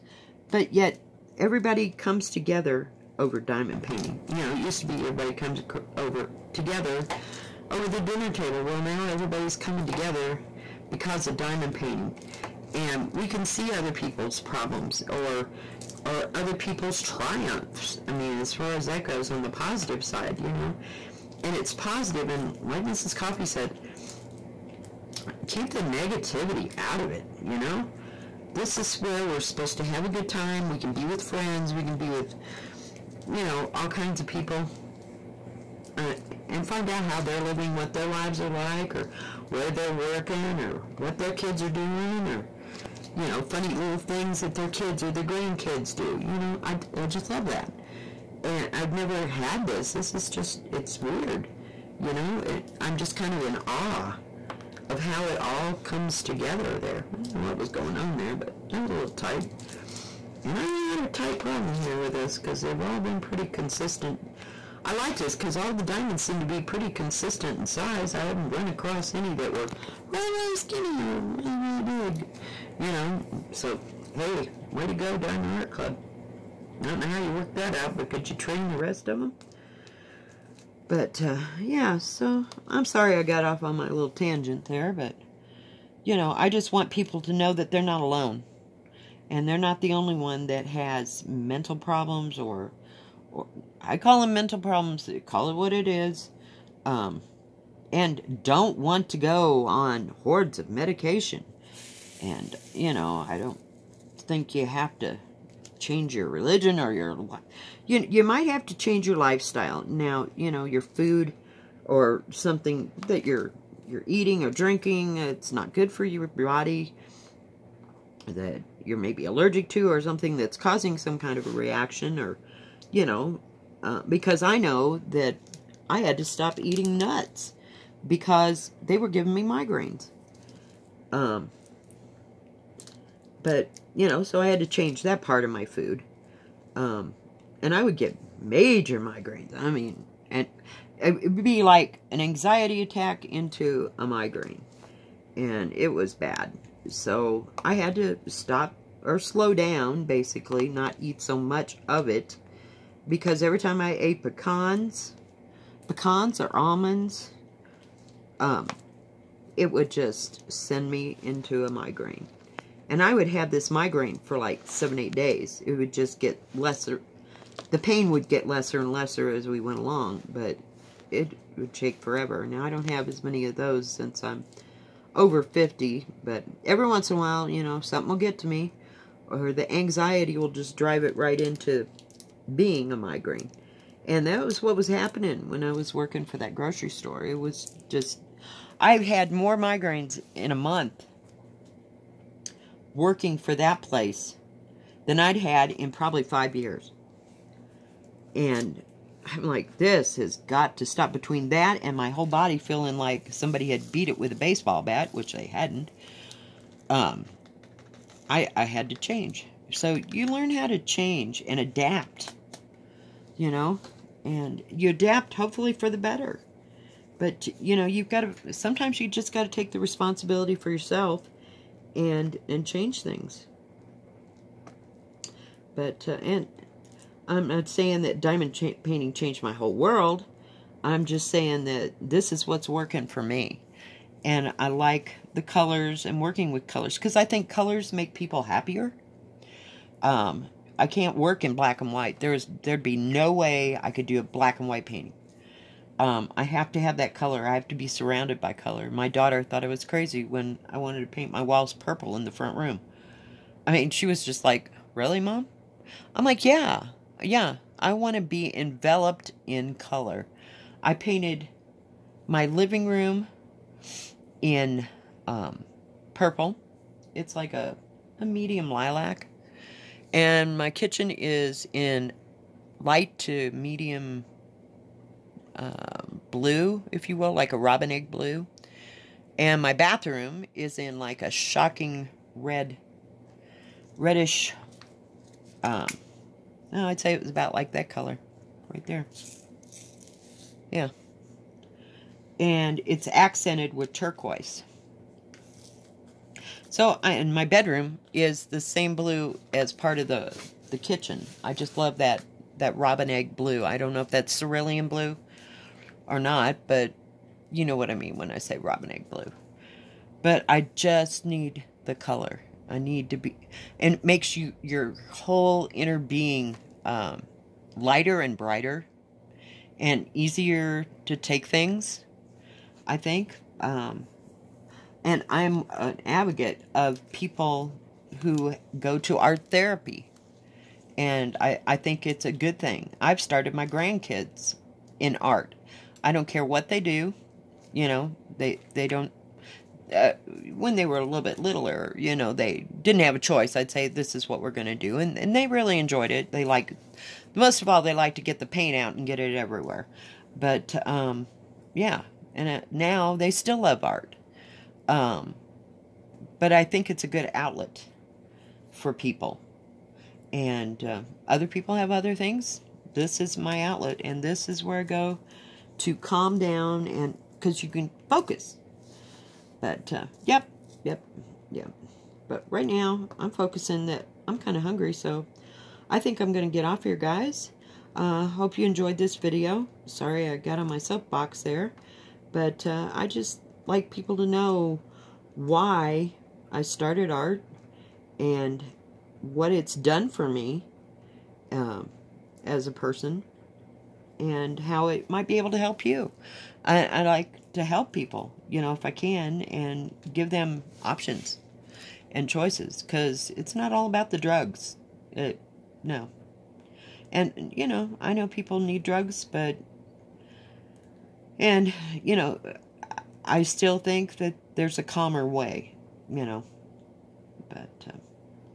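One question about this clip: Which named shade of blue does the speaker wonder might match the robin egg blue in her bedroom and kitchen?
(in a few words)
Cerulean blue.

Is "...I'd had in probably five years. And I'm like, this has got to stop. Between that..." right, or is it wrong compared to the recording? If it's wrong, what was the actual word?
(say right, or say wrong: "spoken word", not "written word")
right.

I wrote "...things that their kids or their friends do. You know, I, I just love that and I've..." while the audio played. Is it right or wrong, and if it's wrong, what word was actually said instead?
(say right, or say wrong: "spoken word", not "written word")
wrong: "grandkids", not "friends".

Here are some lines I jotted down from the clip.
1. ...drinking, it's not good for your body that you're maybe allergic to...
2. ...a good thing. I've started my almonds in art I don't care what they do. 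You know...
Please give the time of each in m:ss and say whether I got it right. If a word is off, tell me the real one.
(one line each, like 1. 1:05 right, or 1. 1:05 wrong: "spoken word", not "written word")
1. 1:54 right
2. 5:32 wrong: "grandkids", not "almonds".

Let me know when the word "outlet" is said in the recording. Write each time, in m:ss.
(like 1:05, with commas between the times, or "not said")
5:57, 6:03.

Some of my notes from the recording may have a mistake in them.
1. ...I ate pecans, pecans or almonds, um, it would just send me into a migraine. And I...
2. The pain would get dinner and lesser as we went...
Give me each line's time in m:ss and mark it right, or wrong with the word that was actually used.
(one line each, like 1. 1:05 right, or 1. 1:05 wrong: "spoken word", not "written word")
1. 2:33 right
2. 2:47 wrong: "lesser", not "dinner".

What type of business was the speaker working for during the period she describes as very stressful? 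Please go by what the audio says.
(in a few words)
Grocery store.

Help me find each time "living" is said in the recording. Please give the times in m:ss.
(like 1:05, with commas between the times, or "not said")
0:37, 4:22.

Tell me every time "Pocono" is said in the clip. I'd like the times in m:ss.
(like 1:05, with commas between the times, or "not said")
not said.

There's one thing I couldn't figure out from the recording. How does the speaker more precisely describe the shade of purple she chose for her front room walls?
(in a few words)
Medium lilac.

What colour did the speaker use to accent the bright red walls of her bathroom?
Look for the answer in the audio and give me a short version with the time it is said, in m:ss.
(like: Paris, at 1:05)
Turquoise, at 4:53.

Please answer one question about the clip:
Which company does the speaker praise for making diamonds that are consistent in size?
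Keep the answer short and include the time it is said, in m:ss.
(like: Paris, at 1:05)
Diamond Art Club, at 1:15.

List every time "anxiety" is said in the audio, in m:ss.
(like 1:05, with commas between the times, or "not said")
2:22, 2:59.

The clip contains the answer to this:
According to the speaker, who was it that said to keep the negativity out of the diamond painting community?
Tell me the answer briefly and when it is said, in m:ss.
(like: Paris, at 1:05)
Mrs. Coffee, at 0:22.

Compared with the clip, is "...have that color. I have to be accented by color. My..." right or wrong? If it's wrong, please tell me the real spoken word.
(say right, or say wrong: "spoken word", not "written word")
wrong: "surrounded", not "accented".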